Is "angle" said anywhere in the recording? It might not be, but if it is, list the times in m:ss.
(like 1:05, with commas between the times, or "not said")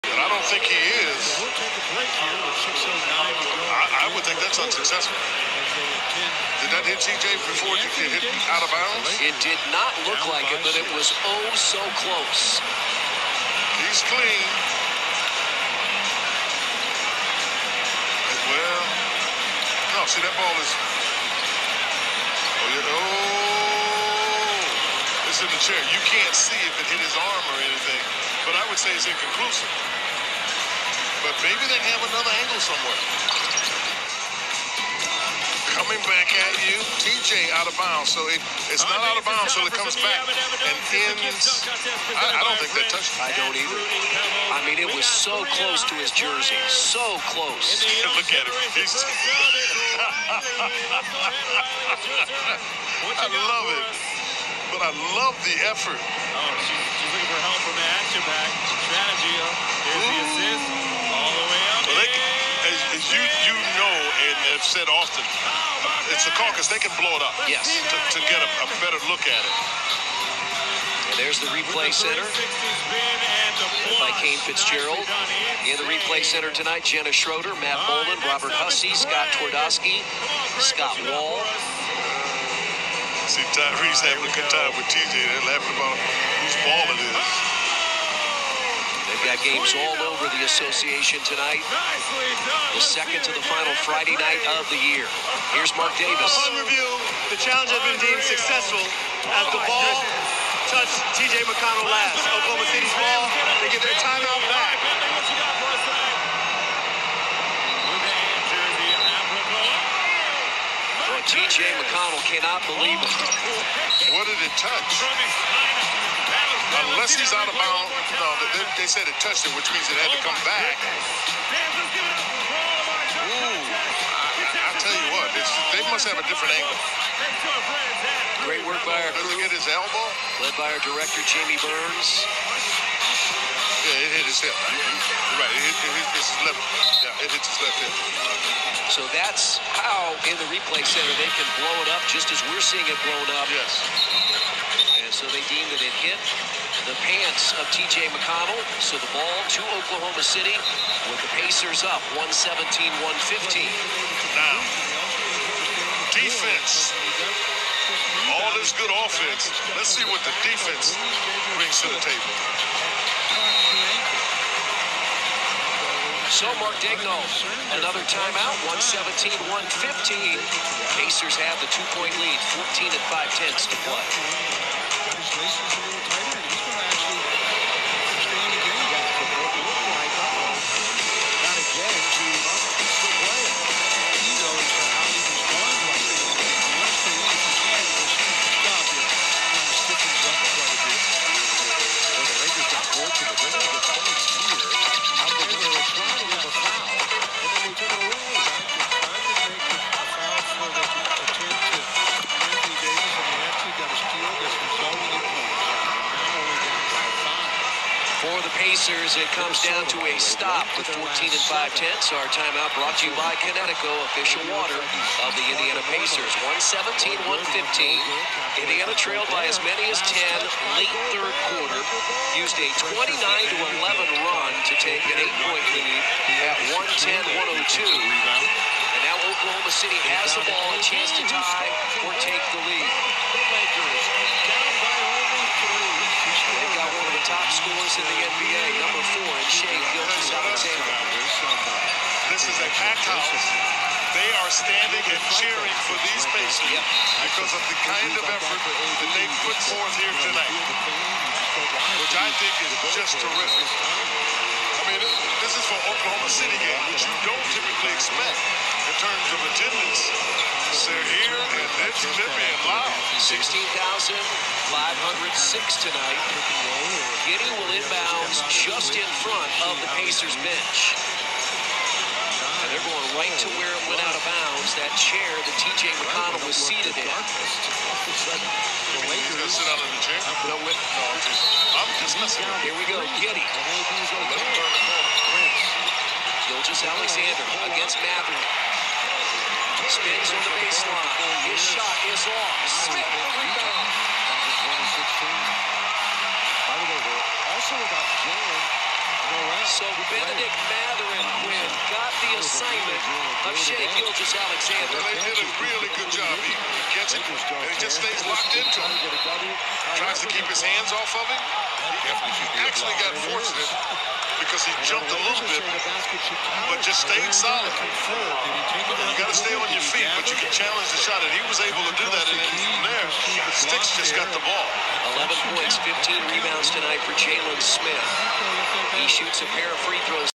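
0:32, 2:06.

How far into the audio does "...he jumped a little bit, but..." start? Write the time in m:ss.
5:14.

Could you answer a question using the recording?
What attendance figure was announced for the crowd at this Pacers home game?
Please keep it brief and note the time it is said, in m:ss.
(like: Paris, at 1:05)
16,506, at 4:23.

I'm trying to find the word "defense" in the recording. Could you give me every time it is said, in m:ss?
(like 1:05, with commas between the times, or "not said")
2:36, 2:40.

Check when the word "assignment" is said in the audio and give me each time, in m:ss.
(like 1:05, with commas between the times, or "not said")
5:02.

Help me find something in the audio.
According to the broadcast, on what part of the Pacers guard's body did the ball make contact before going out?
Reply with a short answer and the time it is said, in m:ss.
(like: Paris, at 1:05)
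left hip, at 2:17.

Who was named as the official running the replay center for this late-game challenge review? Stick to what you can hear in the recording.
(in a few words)
Kane Fitzgerald.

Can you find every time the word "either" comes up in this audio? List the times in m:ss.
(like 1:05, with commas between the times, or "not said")
0:43.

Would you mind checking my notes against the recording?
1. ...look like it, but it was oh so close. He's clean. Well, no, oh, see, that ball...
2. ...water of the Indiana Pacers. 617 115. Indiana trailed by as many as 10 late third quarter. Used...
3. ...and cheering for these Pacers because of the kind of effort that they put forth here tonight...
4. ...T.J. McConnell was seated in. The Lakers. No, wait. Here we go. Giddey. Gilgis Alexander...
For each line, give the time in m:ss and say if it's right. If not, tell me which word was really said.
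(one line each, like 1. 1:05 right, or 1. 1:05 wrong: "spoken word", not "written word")
1. 0:10 right
2. 3:34 wrong: "117", not "617"
3. 4:05 right
4. 4:35 right.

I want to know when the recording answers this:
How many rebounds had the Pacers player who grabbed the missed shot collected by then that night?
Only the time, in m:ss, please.
5:25.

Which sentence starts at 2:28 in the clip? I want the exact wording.
So the ball to Oklahoma City with the Pacers up 117 115.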